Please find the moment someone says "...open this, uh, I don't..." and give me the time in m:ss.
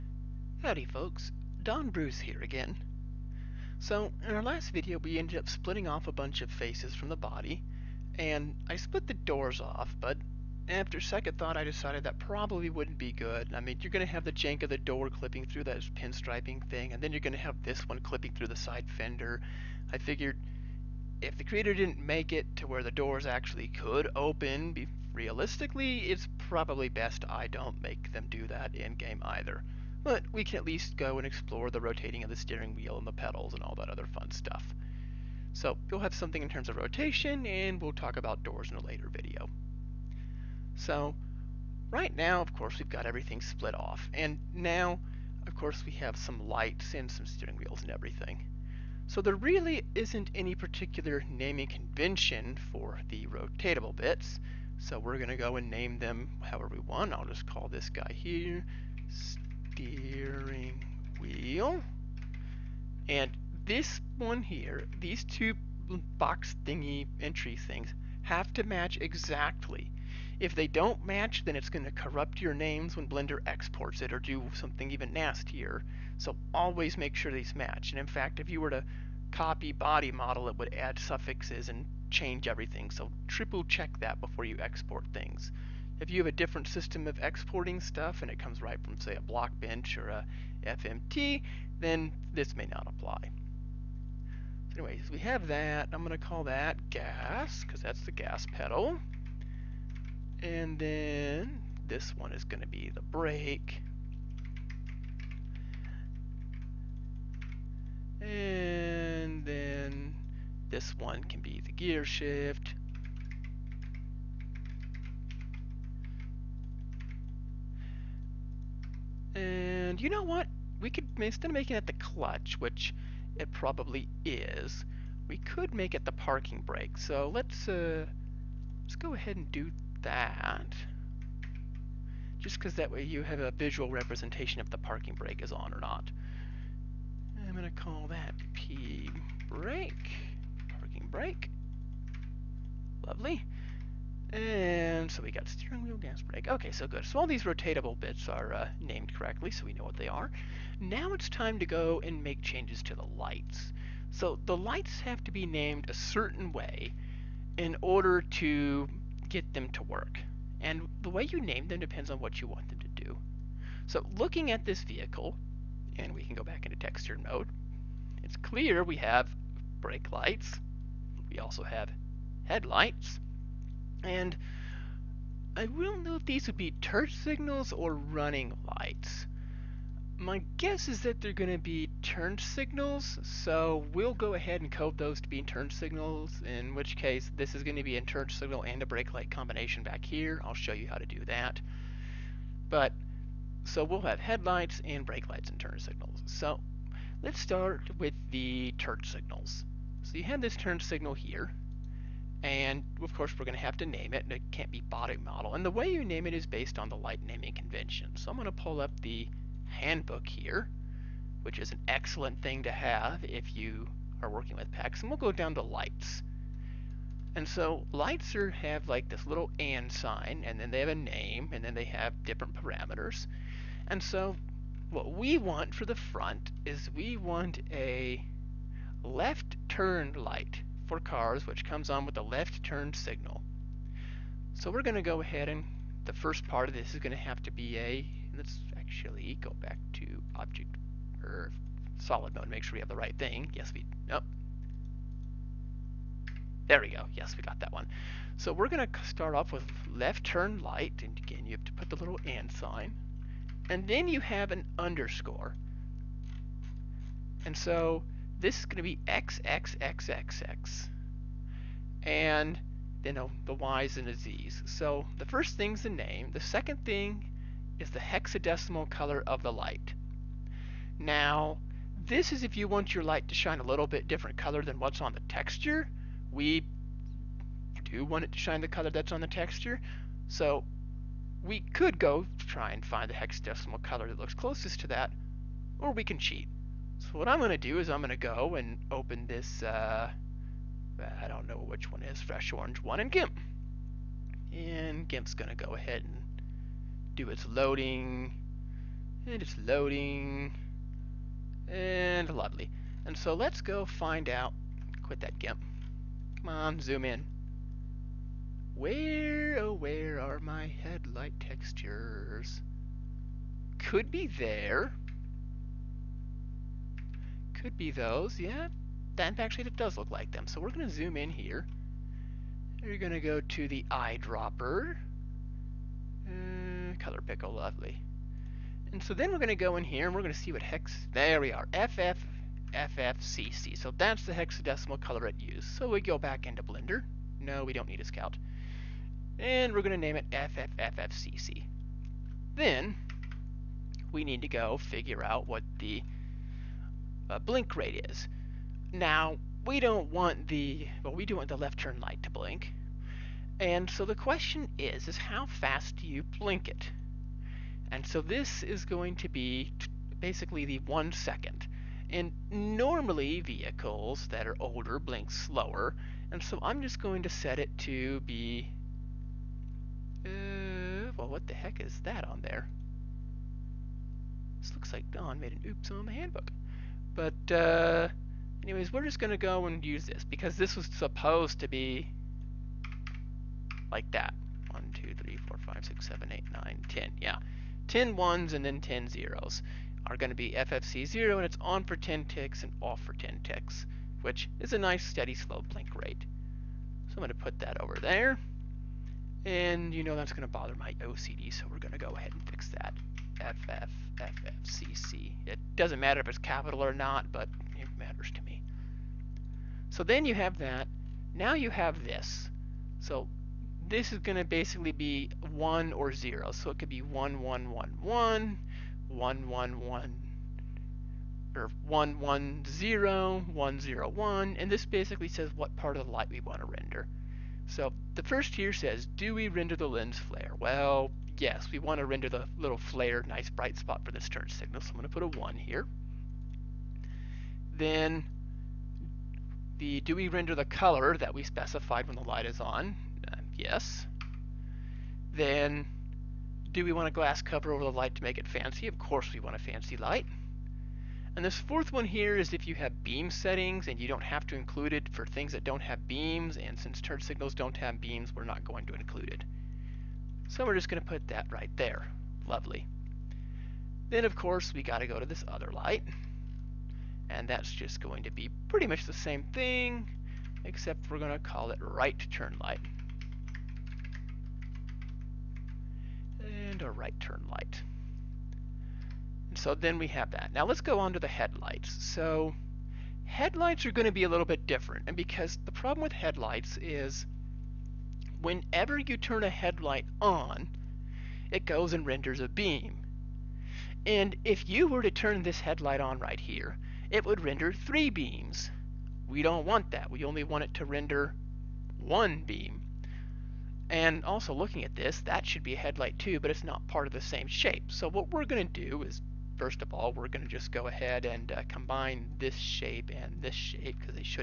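4:48.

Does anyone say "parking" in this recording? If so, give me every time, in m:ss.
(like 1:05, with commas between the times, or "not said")
2:06, 2:14, 2:20.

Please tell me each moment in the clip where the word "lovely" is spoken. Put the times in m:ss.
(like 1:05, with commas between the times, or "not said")
2:23, 5:02, 5:27, 7:42.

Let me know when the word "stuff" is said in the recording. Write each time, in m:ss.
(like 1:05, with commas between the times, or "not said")
0:34, 1:27.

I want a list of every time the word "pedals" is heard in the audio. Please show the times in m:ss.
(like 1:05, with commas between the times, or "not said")
0:33, 1:38.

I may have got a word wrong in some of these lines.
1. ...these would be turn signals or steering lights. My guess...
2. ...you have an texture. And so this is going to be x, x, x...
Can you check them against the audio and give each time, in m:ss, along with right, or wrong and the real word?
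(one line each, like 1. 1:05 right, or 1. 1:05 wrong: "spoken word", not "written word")
1. 2:56 wrong: "running", not "steering"
2. 4:14 wrong: "underscore", not "texture".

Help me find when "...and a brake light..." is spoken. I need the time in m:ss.
3:08.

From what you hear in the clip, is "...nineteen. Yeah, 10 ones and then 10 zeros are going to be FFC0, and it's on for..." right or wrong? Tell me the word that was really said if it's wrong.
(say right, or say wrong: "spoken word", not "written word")
wrong: "ten", not "nineteen".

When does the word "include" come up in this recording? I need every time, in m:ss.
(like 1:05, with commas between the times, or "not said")
7:34, 7:38.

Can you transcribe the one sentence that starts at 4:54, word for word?
And GIMP's going to go ahead and do its loading.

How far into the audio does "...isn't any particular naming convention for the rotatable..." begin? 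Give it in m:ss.
0:49.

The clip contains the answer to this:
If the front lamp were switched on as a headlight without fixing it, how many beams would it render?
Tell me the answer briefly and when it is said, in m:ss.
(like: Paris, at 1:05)
3, at 8:17.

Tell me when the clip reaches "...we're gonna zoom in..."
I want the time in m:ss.
5:20.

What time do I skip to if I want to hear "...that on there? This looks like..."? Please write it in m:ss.
6:12.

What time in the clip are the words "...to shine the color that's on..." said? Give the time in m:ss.
4:38.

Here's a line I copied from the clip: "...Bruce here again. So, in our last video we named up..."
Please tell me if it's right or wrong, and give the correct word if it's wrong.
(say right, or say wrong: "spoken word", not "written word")
wrong: "ended", not "named".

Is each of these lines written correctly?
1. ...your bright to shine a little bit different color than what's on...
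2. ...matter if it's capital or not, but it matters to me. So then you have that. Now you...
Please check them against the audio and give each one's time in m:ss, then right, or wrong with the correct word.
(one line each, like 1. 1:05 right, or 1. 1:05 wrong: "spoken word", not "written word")
1. 4:32 wrong: "light", not "bright"
2. 6:46 right.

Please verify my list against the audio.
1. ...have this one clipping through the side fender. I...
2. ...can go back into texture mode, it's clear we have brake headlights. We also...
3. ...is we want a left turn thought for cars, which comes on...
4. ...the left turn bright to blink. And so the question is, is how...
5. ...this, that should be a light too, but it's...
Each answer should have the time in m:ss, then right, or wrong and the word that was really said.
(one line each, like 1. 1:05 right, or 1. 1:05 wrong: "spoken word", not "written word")
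1. 0:17 right
2. 2:46 wrong: "lights", not "headlights"
3. 3:46 wrong: "light", not "thought"
4. 5:51 wrong: "light", not "bright"
5. 8:24 wrong: "headlight", not "light".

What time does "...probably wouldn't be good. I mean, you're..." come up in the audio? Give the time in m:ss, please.
0:12.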